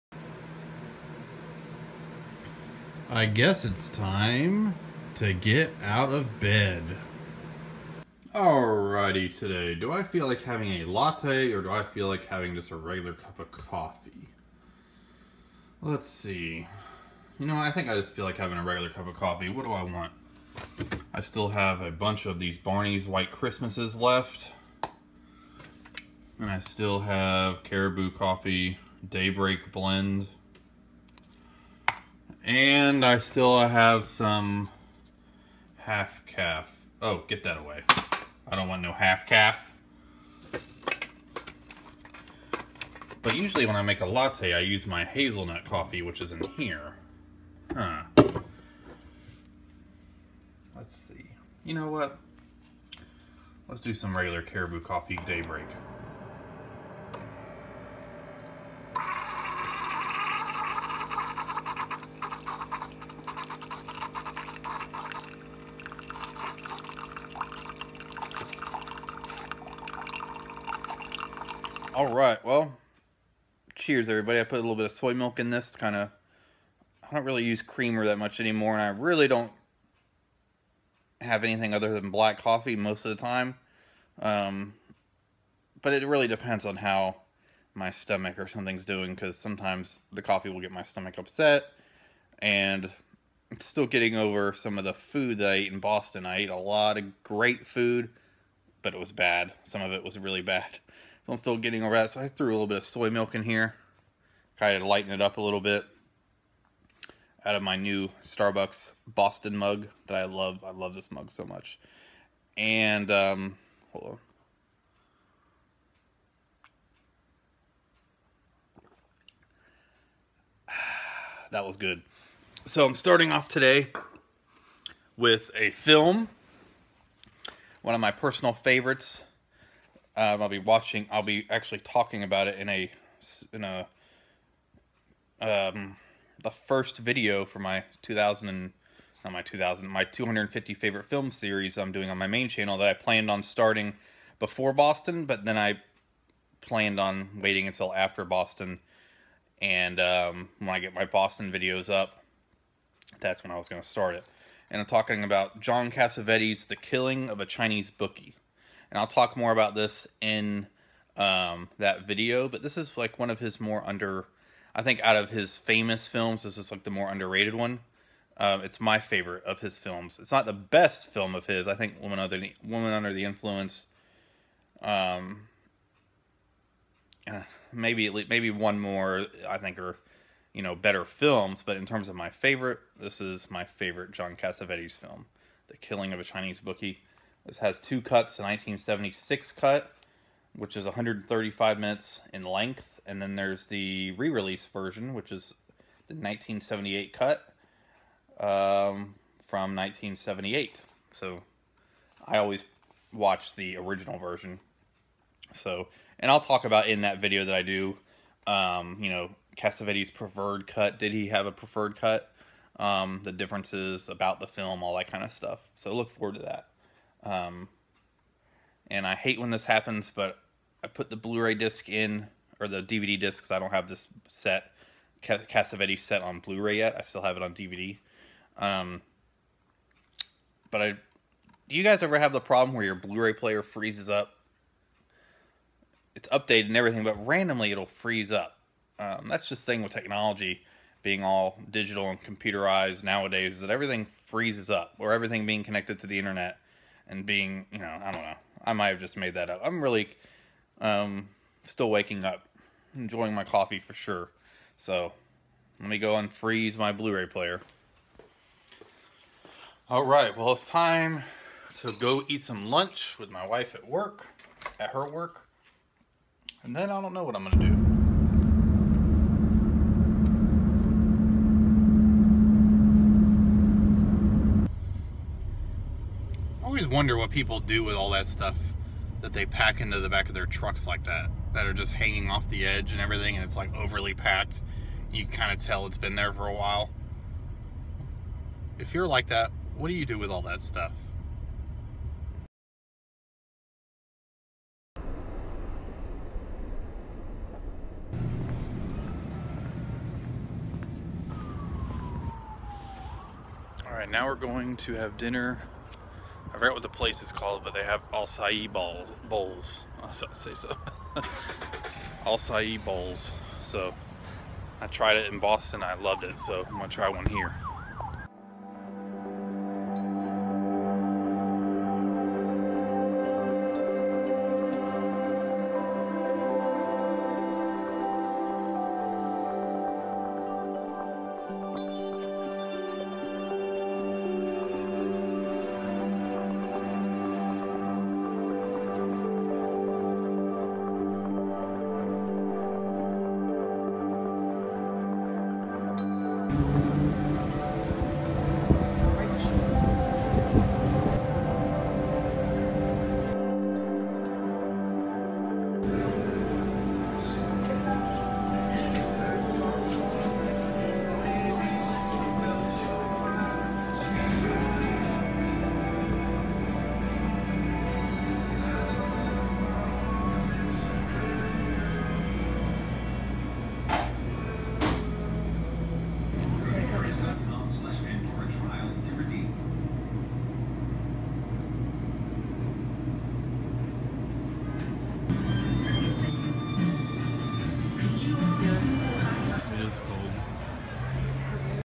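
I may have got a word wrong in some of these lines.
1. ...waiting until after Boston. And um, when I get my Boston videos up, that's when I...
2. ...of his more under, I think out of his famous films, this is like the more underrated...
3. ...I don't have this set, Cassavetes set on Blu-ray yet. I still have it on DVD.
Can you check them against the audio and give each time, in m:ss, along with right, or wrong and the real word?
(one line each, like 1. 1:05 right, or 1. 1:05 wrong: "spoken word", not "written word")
1. 2:27 right
2. 2:43 right
3. 3:43 right.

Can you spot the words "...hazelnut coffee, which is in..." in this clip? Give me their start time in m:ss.
0:45.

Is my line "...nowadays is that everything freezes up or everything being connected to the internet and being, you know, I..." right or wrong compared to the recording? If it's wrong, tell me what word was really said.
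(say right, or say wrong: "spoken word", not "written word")
right.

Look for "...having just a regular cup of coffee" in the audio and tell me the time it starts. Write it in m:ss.
0:12.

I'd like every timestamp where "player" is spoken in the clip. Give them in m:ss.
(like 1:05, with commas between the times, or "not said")
3:53, 4:17.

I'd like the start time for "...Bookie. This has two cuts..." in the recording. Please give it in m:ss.
3:06.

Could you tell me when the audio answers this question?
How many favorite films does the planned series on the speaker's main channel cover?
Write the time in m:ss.
2:20.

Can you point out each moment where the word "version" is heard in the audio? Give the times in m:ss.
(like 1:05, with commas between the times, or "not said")
3:14, 3:24.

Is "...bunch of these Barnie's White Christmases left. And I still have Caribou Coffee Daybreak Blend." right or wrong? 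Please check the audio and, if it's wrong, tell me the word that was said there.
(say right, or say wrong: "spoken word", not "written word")
right.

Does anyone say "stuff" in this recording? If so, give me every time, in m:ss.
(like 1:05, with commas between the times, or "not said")
3:35, 4:38, 4:50.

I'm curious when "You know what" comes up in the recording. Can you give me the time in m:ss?
0:51.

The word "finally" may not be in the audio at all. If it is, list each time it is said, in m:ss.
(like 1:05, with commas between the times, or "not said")
not said.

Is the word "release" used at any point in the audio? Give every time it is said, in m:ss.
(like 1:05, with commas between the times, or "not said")
3:14.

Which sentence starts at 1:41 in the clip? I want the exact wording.
So I'm still getting over that.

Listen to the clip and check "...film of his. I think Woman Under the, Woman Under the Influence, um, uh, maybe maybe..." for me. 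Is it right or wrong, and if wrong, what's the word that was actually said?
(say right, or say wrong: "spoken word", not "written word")
right.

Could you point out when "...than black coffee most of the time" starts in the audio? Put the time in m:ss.
1:21.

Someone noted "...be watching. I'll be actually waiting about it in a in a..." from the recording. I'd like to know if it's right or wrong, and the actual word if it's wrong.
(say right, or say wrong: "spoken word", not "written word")
wrong: "talking", not "waiting".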